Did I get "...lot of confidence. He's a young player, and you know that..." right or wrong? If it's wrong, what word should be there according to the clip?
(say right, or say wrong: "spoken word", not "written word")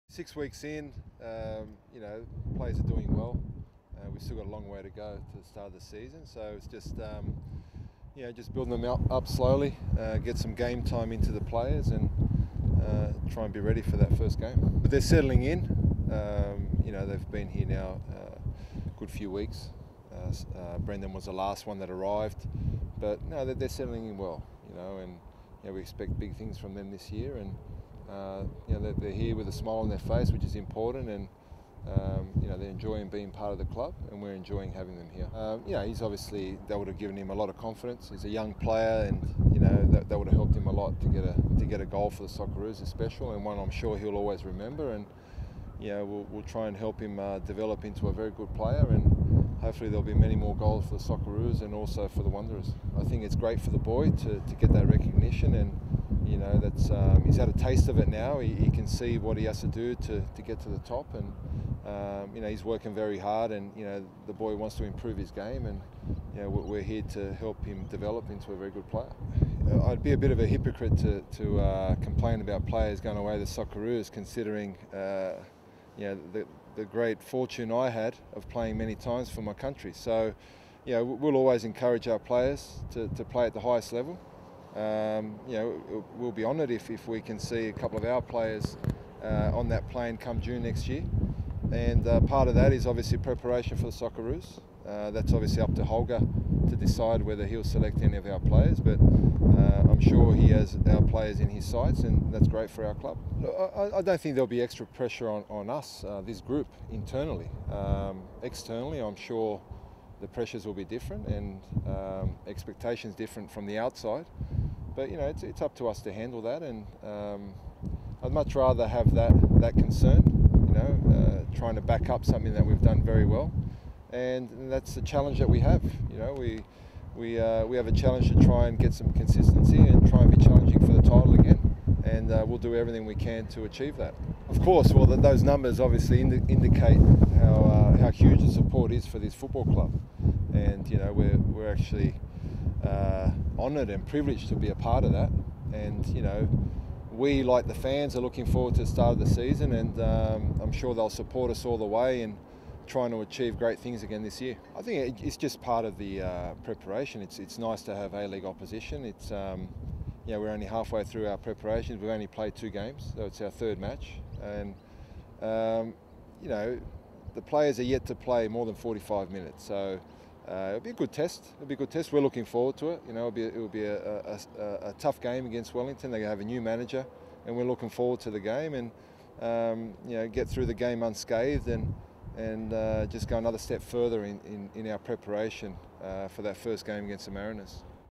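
right.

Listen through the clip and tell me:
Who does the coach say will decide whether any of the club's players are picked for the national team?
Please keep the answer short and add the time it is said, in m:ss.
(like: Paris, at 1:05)
Holger, at 1:35.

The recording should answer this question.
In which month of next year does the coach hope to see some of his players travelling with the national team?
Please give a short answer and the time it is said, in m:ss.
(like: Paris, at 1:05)
June, at 1:30.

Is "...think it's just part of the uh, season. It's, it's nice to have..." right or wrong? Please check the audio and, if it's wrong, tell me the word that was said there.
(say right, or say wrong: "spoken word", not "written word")
wrong: "preparation", not "season".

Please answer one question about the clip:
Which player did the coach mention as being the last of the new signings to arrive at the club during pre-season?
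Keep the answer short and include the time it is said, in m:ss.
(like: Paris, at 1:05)
Brendan, at 0:20.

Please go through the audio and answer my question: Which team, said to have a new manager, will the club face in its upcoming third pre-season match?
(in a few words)
Wellington.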